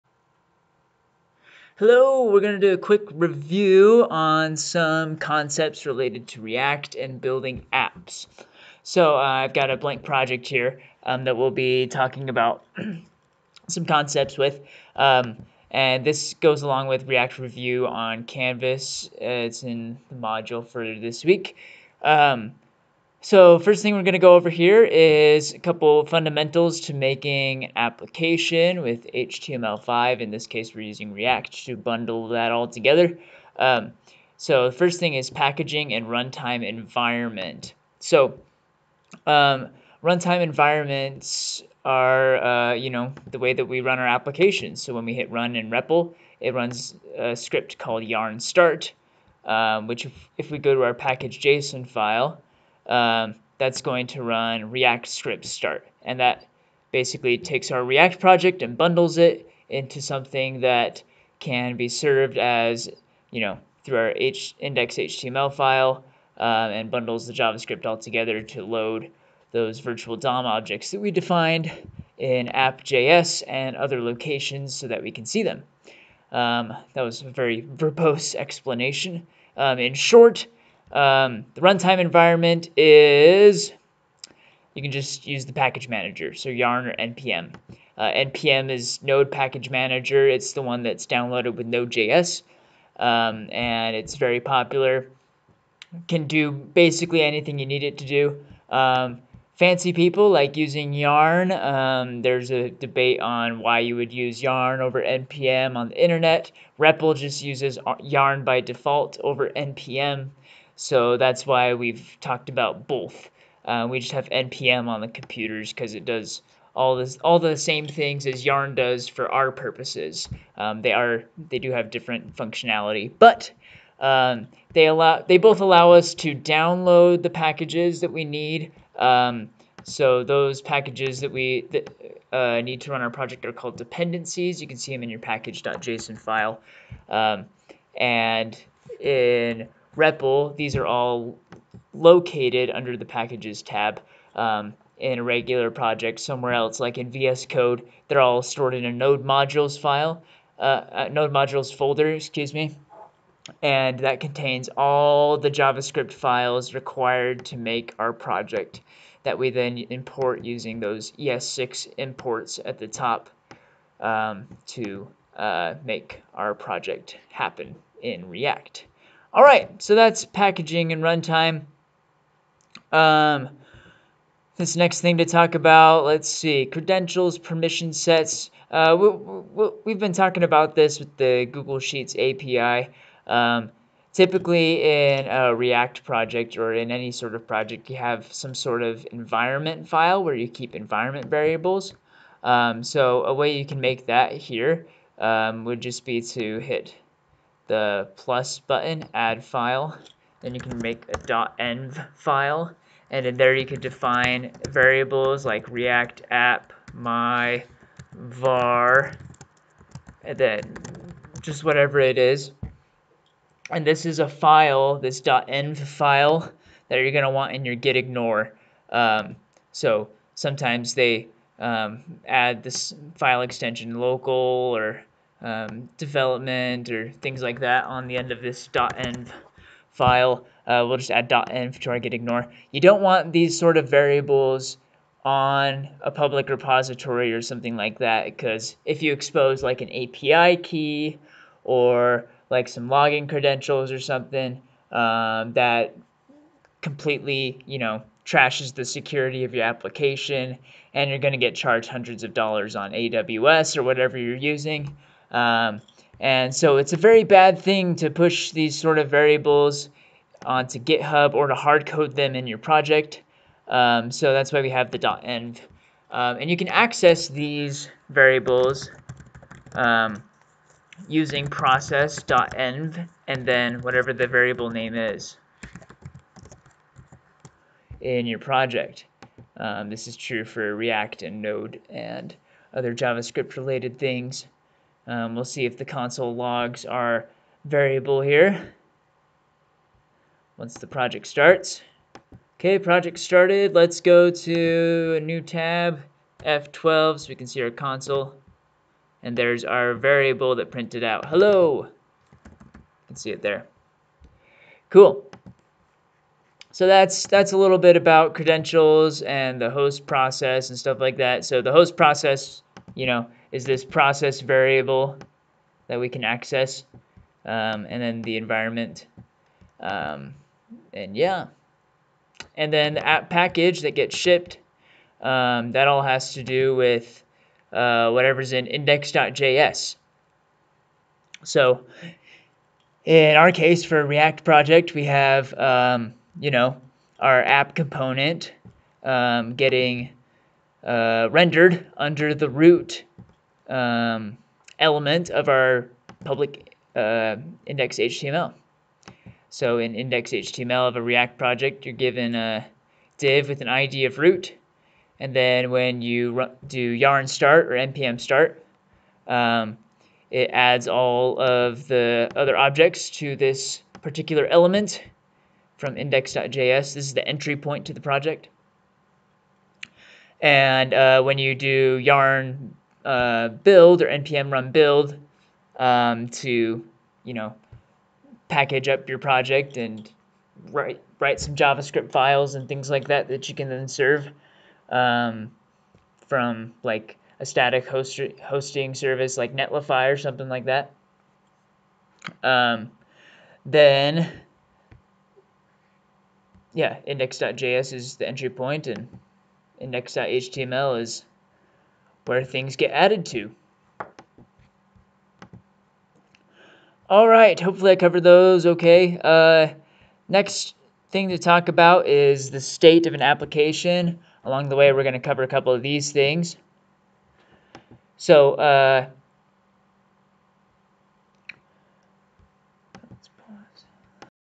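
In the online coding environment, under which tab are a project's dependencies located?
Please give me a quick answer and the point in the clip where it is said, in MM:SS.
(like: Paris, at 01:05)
packages tab, at 02:23.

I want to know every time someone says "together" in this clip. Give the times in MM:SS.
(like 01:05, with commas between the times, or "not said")
00:32, 01:07.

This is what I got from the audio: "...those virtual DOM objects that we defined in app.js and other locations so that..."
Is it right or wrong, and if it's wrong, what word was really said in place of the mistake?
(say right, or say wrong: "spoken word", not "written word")
right.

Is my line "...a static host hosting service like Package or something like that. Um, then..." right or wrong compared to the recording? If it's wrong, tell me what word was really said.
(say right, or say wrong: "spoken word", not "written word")
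wrong: "Netlify", not "Package".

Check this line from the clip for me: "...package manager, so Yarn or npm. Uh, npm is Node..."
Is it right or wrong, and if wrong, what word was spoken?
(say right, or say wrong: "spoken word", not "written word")
right.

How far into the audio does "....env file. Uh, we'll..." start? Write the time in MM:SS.
03:48.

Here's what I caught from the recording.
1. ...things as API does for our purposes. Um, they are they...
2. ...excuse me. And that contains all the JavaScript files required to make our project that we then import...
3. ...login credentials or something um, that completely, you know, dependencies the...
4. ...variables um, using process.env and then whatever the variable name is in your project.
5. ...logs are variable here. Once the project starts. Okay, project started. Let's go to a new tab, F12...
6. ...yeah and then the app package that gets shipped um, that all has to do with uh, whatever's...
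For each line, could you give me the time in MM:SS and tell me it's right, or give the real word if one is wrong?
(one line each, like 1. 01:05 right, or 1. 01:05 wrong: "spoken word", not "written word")
1. 01:57 wrong: "Yarn", not "API"
2. 02:32 right
3. 04:02 wrong: "trashes", not "dependencies"
4. 04:28 right
5. 04:46 right
6. 05:21 right.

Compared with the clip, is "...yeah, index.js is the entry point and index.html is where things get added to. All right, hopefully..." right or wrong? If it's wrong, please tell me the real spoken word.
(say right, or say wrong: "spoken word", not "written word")
right.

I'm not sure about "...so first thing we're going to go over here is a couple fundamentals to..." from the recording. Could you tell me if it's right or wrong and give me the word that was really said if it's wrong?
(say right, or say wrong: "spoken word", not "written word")
right.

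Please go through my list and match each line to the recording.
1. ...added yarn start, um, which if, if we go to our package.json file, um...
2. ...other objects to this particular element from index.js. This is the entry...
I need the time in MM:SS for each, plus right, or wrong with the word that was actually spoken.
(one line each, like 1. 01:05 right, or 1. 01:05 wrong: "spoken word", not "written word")
1. 00:47 wrong: "called", not "added"
2. 06:02 right.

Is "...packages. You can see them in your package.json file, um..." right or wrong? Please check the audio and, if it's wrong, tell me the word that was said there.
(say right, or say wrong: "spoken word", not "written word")
wrong: "dependencies", not "packages".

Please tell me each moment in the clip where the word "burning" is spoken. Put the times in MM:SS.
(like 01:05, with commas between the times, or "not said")
not said.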